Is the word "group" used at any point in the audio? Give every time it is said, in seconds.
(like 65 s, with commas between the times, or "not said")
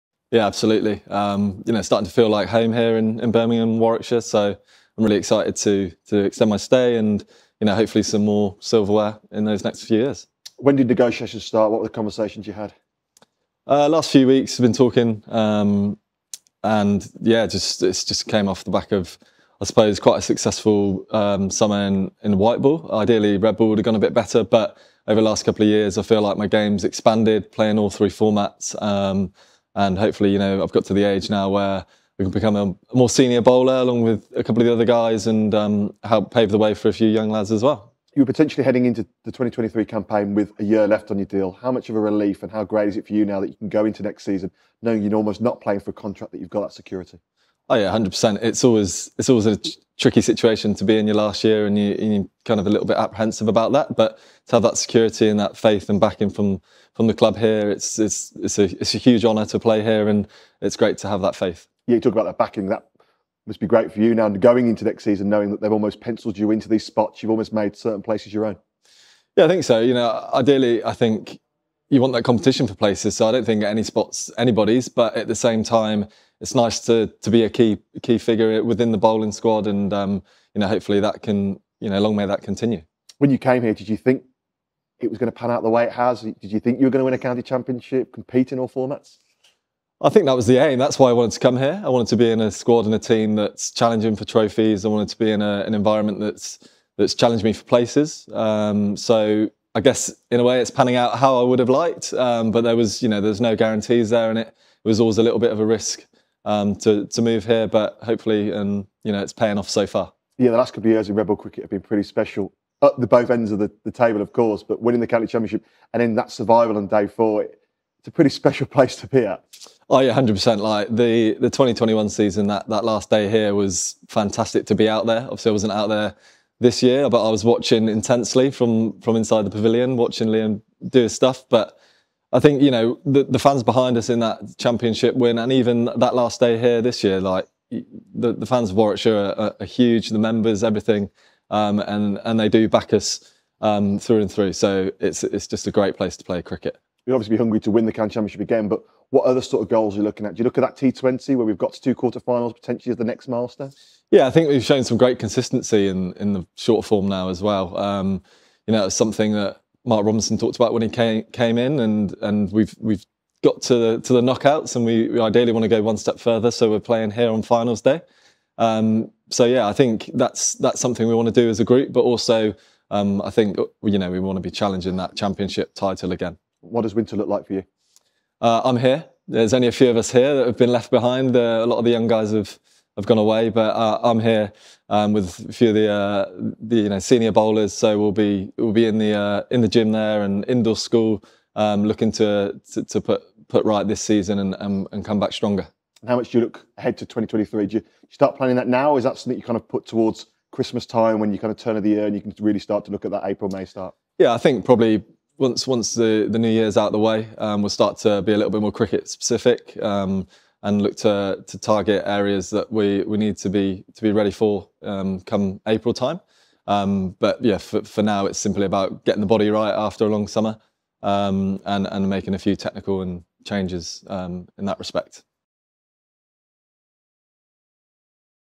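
171 s.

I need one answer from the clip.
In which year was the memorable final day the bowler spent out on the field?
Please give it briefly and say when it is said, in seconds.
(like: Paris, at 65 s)
2021, at 121 s.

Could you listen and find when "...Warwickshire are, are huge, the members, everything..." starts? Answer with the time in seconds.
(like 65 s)
138 s.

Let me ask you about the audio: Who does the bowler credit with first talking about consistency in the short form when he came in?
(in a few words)
Mark Robinson.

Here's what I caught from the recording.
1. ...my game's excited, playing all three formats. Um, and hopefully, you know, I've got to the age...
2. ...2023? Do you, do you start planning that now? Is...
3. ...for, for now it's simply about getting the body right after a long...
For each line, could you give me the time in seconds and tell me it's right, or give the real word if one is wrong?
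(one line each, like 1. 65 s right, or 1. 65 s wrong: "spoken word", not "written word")
1. 26 s wrong: "expanded", not "excited"
2. 197 s right
3. 217 s right.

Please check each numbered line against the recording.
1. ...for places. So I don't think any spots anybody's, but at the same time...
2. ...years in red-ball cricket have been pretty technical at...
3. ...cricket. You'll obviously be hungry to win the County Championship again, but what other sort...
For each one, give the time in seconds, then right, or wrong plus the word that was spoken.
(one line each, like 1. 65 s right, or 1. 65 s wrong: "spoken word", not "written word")
1. 72 s right
2. 110 s wrong: "special", not "technical"
3. 146 s right.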